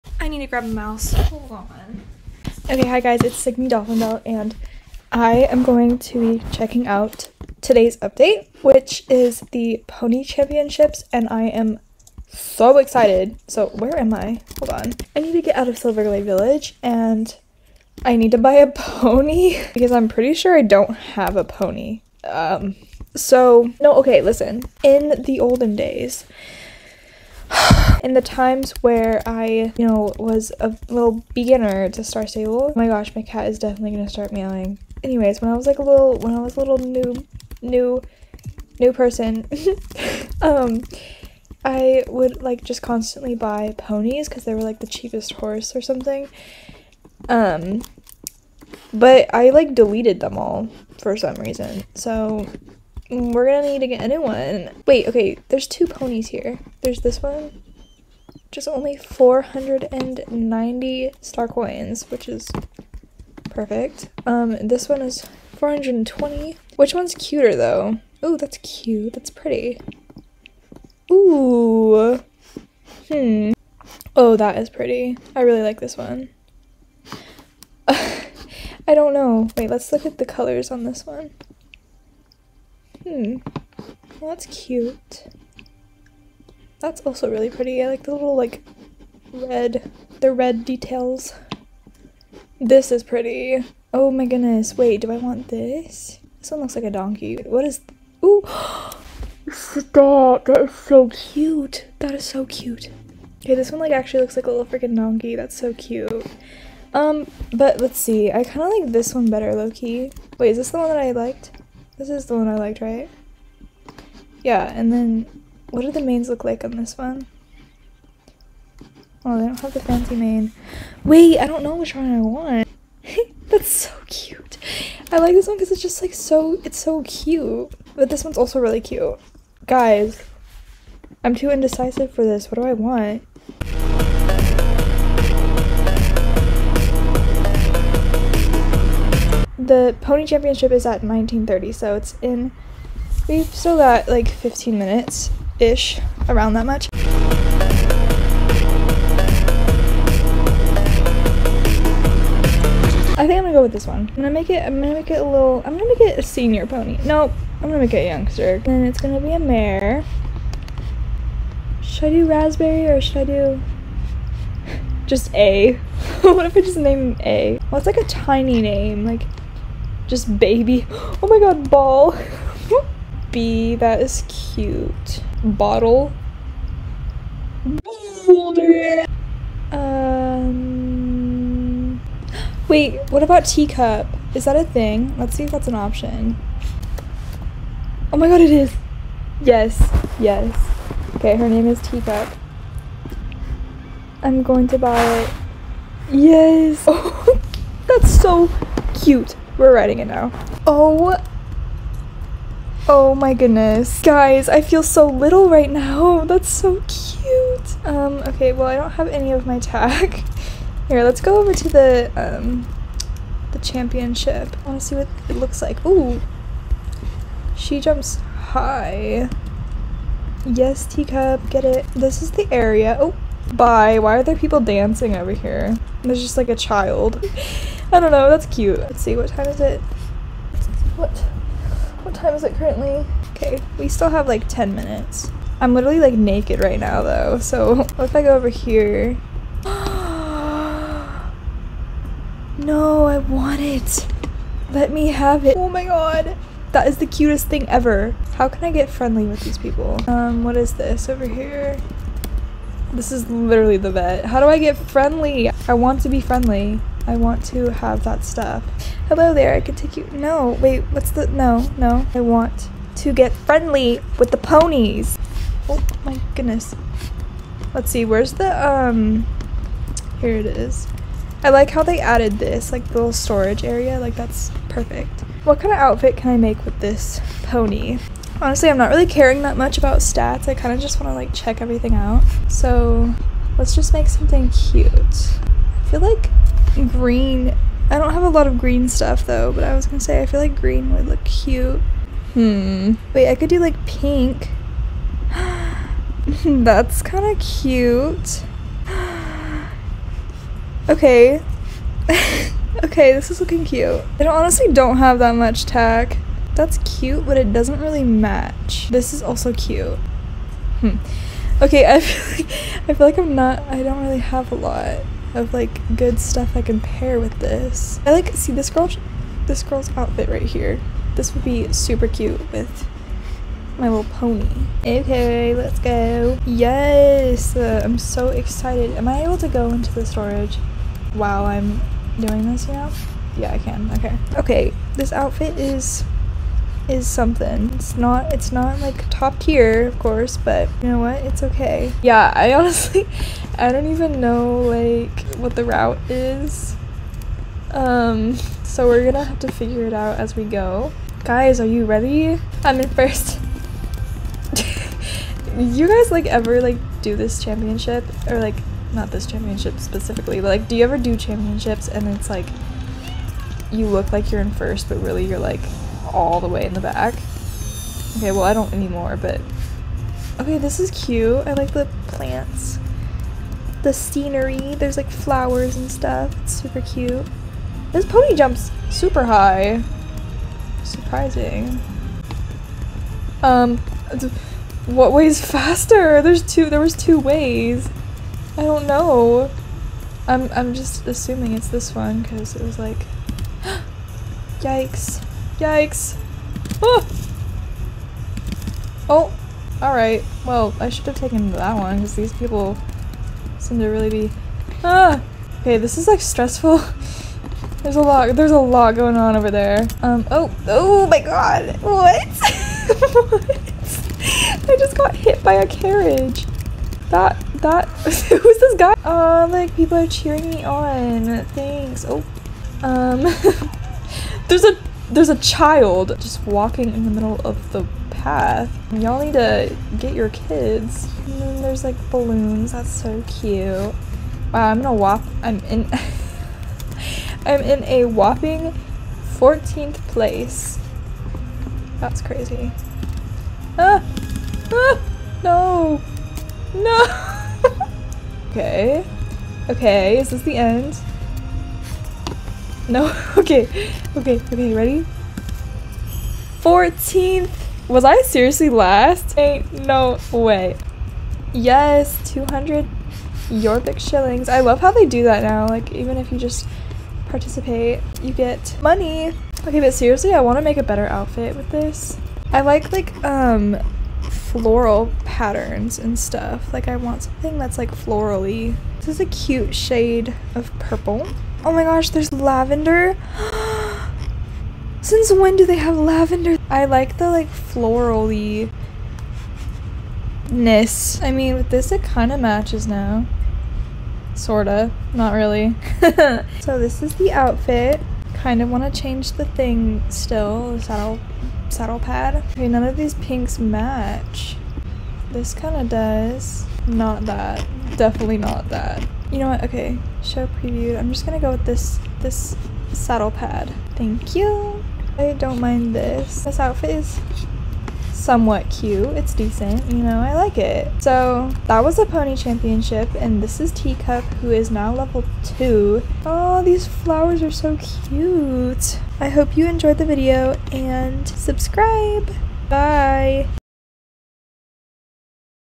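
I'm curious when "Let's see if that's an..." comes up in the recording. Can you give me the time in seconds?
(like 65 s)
185 s.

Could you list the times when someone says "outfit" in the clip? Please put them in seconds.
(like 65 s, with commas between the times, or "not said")
275 s, 319 s, 335 s, 471 s, 497 s, 516 s.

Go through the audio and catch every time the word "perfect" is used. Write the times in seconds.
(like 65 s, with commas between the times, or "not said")
63 s, 274 s.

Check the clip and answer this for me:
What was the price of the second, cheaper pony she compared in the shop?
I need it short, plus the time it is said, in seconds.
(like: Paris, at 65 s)
420, at 65 s.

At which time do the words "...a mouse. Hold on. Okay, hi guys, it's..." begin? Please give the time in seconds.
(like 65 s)
0 s.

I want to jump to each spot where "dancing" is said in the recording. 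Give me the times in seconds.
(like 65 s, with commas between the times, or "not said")
224 s.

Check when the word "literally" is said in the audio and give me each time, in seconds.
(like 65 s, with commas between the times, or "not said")
235 s, 253 s.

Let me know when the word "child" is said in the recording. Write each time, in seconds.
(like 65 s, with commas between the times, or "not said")
226 s, 425 s.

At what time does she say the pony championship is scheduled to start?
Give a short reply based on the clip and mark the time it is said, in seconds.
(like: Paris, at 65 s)
1930, at 141 s.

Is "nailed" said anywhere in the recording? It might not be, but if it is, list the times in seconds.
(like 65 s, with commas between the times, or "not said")
not said.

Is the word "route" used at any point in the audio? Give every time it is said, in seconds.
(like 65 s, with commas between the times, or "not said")
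345 s.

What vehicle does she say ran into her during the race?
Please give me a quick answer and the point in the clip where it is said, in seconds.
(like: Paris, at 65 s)
a carriage, at 415 s.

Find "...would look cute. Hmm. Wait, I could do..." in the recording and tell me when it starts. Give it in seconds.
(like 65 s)
290 s.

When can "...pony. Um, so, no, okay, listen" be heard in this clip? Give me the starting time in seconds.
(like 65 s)
21 s.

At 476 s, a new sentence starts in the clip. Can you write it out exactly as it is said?
Like, I want something that's, like, florally.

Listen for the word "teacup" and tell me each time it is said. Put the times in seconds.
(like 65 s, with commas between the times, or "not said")
183 s, 191 s, 220 s, 523 s.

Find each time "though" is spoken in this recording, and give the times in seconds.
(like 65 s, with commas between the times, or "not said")
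67 s, 237 s, 289 s.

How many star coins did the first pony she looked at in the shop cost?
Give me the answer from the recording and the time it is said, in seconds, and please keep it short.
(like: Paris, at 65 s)
490, at 58 s.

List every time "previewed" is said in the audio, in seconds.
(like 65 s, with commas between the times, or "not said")
510 s.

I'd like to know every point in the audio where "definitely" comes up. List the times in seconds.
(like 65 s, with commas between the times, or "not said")
33 s, 507 s.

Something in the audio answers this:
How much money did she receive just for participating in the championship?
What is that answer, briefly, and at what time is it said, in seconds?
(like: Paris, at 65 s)
200 shillings, at 462 s.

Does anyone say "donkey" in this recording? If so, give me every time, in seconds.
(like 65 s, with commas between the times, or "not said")
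96 s, 104 s.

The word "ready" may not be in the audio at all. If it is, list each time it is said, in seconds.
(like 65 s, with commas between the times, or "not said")
351 s, 454 s.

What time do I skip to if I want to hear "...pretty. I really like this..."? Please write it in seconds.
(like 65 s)
74 s.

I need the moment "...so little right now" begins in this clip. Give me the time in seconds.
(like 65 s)
204 s.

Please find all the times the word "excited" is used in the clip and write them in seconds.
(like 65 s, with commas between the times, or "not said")
12 s, 328 s.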